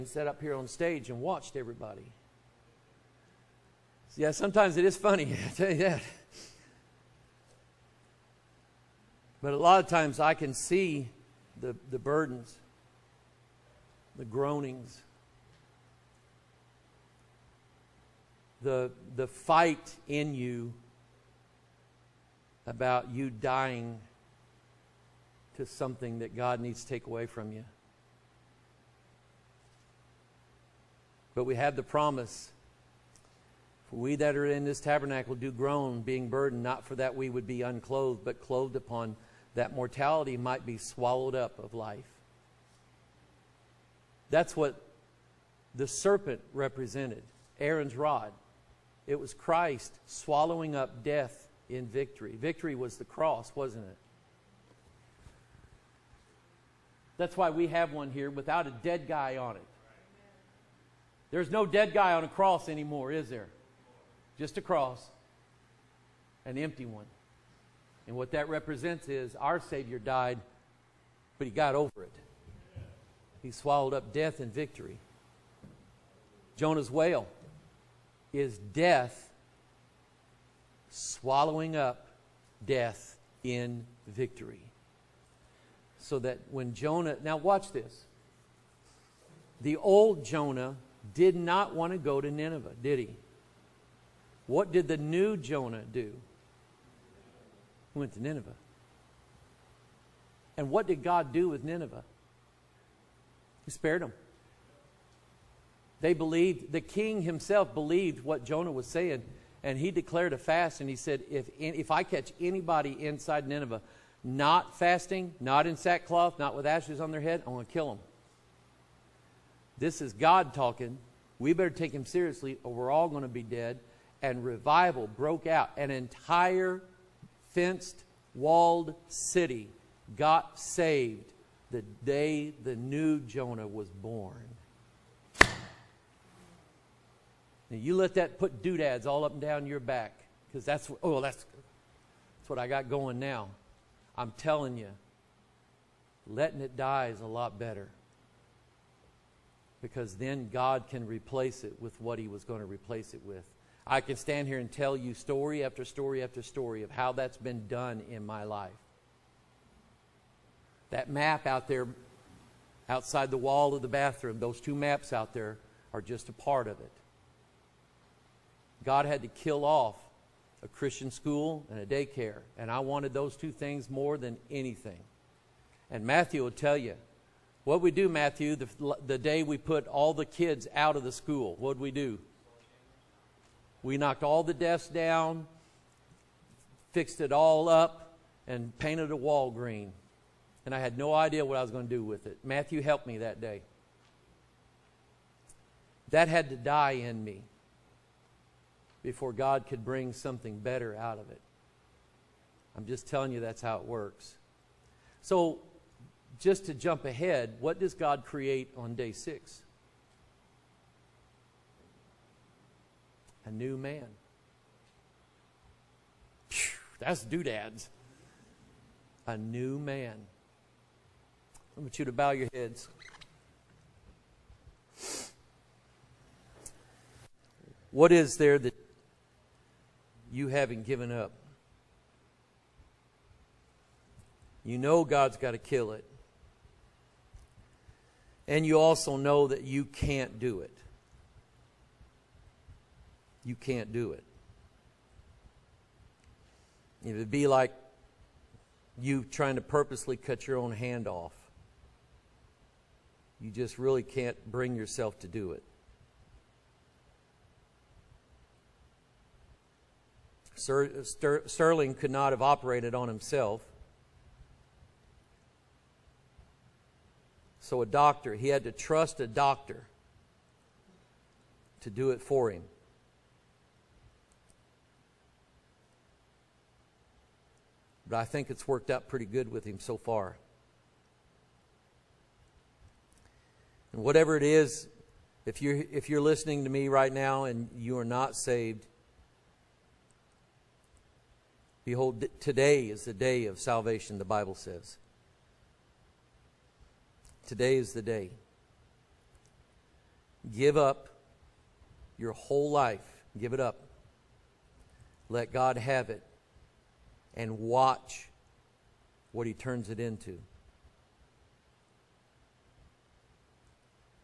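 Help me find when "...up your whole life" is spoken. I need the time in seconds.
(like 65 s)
300 s.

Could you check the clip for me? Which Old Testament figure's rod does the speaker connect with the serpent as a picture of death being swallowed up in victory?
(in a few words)
Aaron.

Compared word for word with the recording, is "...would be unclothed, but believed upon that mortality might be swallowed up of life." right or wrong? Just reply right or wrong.
wrong.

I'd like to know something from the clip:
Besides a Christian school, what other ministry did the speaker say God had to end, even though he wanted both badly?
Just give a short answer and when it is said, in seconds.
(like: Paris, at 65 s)
a daycare, at 171 s.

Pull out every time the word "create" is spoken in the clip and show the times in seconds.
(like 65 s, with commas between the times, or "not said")
208 s.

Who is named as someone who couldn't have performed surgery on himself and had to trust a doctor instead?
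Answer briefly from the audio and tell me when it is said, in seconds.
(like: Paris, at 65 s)
Sterling, at 260 s.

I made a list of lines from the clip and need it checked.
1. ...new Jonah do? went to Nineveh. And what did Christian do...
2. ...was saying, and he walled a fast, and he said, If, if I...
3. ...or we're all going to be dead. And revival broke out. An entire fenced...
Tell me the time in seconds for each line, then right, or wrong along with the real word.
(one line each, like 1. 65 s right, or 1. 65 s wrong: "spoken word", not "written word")
1. 94 s wrong: "God", not "Christian"
2. 108 s wrong: "declared", not "walled"
3. 122 s right.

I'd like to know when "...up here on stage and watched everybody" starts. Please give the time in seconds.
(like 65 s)
0 s.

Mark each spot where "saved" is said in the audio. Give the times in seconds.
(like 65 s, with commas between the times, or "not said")
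130 s, 288 s.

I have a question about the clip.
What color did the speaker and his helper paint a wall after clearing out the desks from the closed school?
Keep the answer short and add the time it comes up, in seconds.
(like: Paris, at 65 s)
green, at 189 s.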